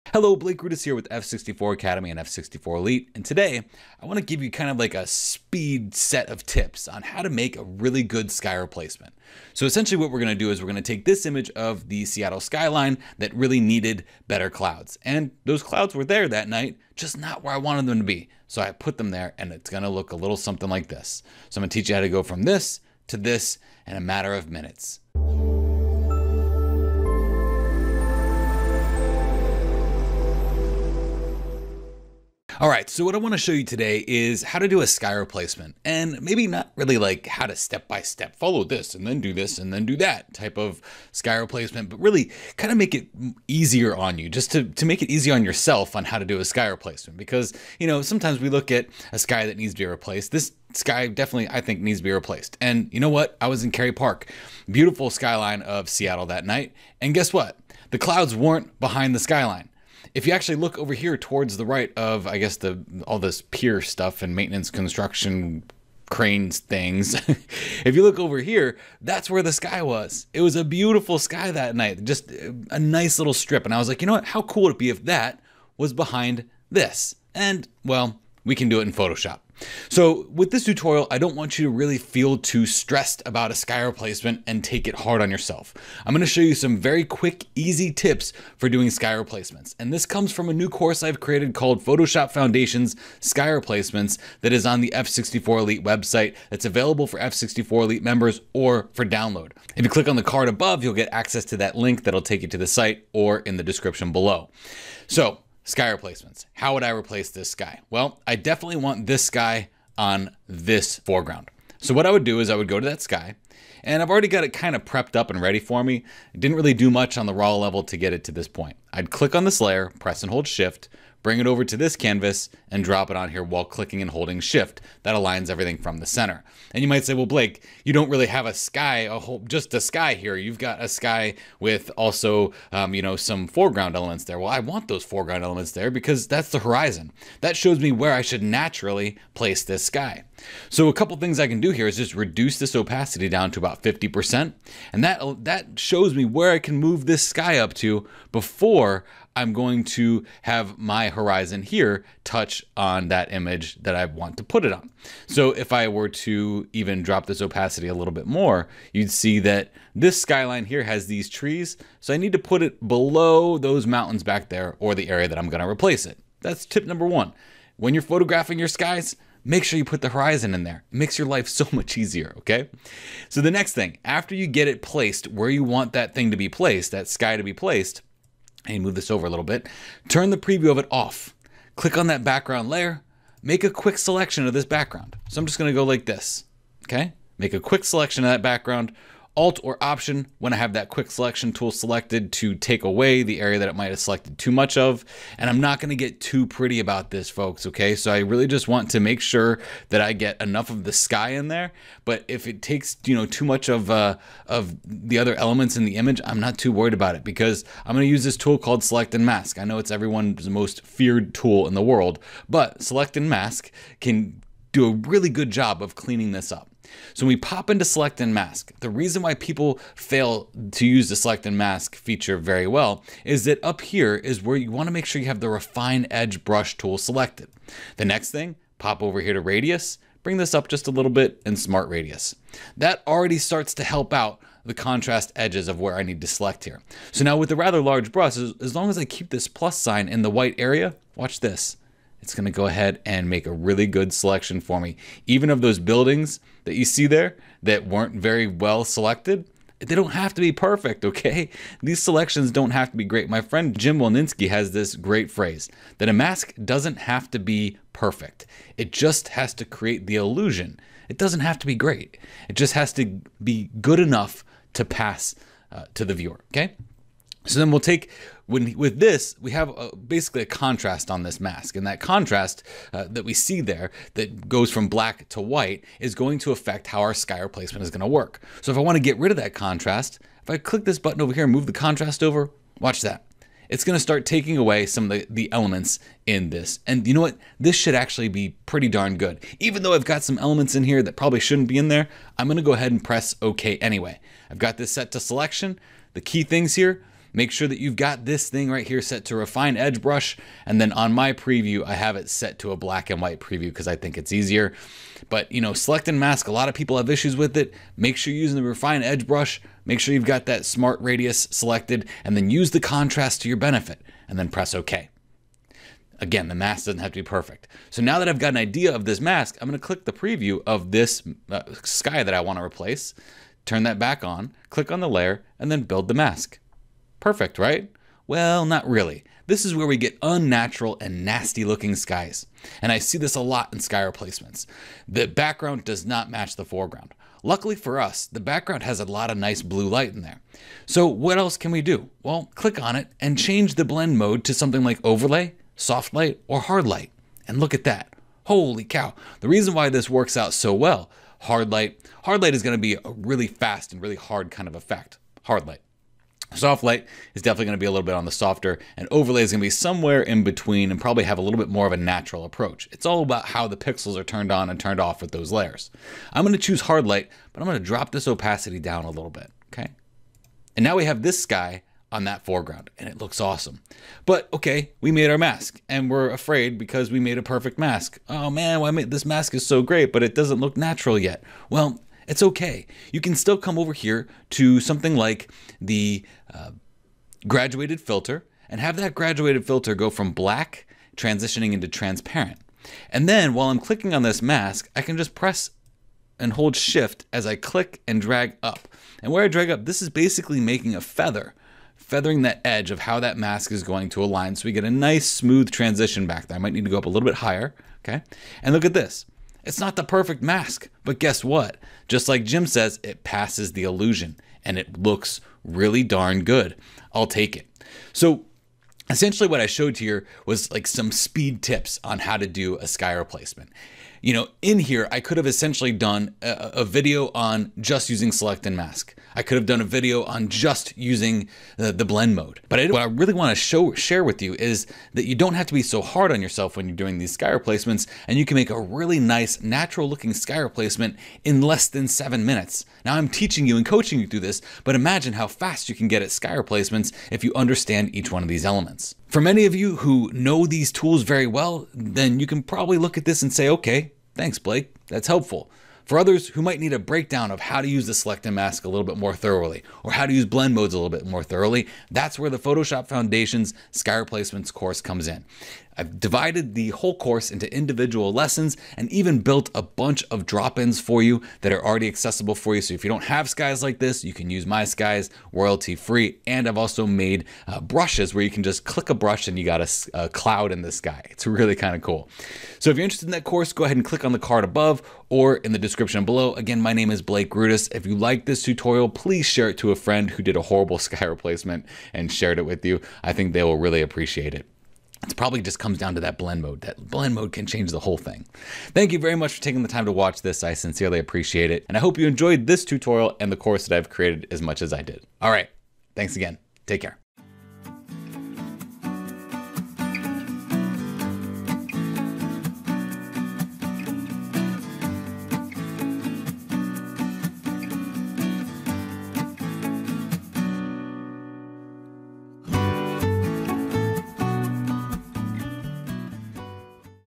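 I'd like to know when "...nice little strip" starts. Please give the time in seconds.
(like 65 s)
72 s.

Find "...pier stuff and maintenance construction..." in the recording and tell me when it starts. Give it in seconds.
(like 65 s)
63 s.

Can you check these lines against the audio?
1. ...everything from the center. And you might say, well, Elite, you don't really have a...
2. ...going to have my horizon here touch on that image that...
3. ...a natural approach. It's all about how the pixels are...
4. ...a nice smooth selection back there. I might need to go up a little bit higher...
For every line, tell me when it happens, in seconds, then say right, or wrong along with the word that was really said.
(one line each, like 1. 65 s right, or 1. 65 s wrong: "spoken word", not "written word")
1. 125 s wrong: "Blake", not "Elite"
2. 149 s right
3. 361 s right
4. 404 s wrong: "transition", not "selection".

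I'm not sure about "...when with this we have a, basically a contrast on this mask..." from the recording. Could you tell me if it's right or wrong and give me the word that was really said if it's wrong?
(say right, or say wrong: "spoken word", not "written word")
right.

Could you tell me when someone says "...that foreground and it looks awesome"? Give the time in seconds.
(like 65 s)
372 s.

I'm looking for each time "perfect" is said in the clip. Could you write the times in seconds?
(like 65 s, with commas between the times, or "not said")
250 s, 257 s, 317 s, 327 s, 377 s, 410 s.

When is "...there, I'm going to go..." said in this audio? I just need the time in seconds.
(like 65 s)
291 s.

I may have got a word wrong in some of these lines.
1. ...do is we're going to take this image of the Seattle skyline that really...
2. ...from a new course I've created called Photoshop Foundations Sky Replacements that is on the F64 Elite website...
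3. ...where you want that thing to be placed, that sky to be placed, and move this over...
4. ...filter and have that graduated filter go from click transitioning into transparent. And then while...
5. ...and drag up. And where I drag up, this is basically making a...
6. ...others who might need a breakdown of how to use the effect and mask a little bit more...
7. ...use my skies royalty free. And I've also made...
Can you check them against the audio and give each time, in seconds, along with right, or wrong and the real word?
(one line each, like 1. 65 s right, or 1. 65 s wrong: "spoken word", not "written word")
1. 10 s right
2. 90 s right
3. 175 s right
4. 388 s wrong: "black", not "click"
5. 398 s right
6. 456 s wrong: "select", not "effect"
7. 474 s right.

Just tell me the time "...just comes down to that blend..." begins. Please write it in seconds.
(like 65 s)
495 s.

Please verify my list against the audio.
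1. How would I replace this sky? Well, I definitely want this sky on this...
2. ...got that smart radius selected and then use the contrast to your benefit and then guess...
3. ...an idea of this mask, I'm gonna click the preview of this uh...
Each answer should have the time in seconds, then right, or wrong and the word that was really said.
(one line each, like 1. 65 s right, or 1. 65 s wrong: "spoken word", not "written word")
1. 106 s right
2. 310 s wrong: "press", not "guess"
3. 318 s right.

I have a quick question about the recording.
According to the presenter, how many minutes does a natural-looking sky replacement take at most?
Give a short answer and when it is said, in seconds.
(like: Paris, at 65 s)
7, at 442 s.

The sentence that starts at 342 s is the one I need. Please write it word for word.
Well, click on it and change the blend mode to something like overlay, soft light, or hard light.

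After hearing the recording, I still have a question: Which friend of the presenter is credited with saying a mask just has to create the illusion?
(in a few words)
Jim Wolninski.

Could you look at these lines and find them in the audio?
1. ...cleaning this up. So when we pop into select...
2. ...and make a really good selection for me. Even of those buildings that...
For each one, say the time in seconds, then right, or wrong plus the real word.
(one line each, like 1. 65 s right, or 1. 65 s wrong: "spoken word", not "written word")
1. 215 s right
2. 243 s right.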